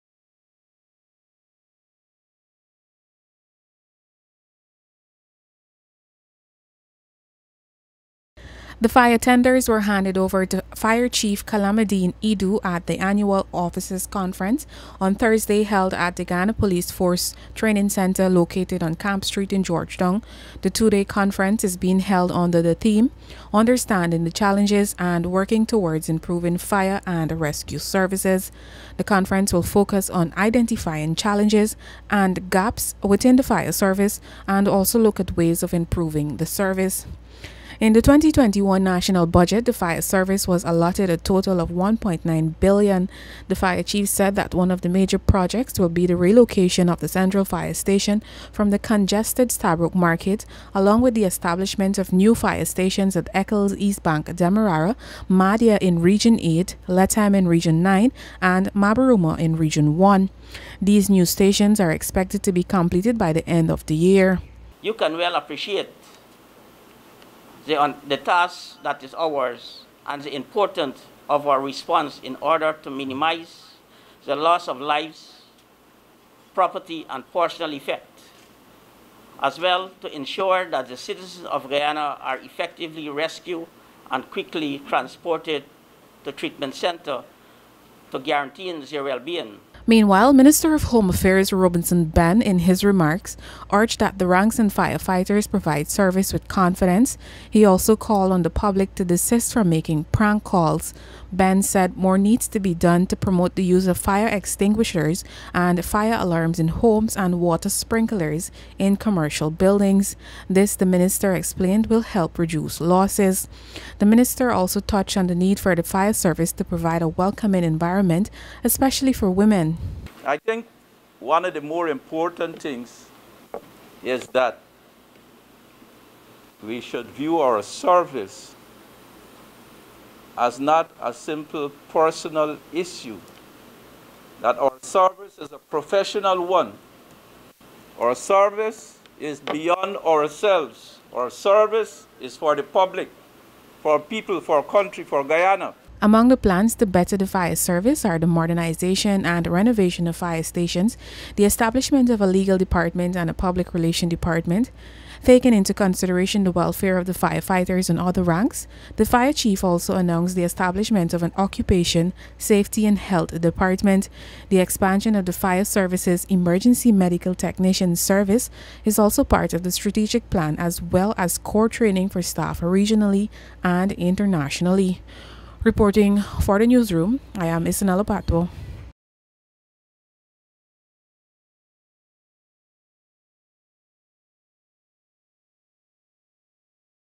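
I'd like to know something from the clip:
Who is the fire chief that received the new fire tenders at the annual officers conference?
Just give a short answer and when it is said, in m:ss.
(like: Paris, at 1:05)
Kalamadeen Edoo, at 0:11.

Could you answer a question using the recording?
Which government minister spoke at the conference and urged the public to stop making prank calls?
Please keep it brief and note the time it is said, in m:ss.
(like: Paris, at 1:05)
Robeson Benn, at 1:31.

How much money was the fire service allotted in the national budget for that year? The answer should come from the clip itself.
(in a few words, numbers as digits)
1.9 billion.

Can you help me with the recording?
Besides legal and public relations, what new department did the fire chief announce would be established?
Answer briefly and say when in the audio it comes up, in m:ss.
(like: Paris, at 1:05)
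Occupation, safety and health, at 2:41.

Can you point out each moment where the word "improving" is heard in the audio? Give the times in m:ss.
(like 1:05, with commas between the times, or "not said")
0:26, 0:35.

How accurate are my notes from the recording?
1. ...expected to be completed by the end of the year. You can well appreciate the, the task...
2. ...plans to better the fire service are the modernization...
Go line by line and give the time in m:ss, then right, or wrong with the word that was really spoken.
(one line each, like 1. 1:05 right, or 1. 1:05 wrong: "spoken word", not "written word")
1. 1:01 right
2. 2:26 right.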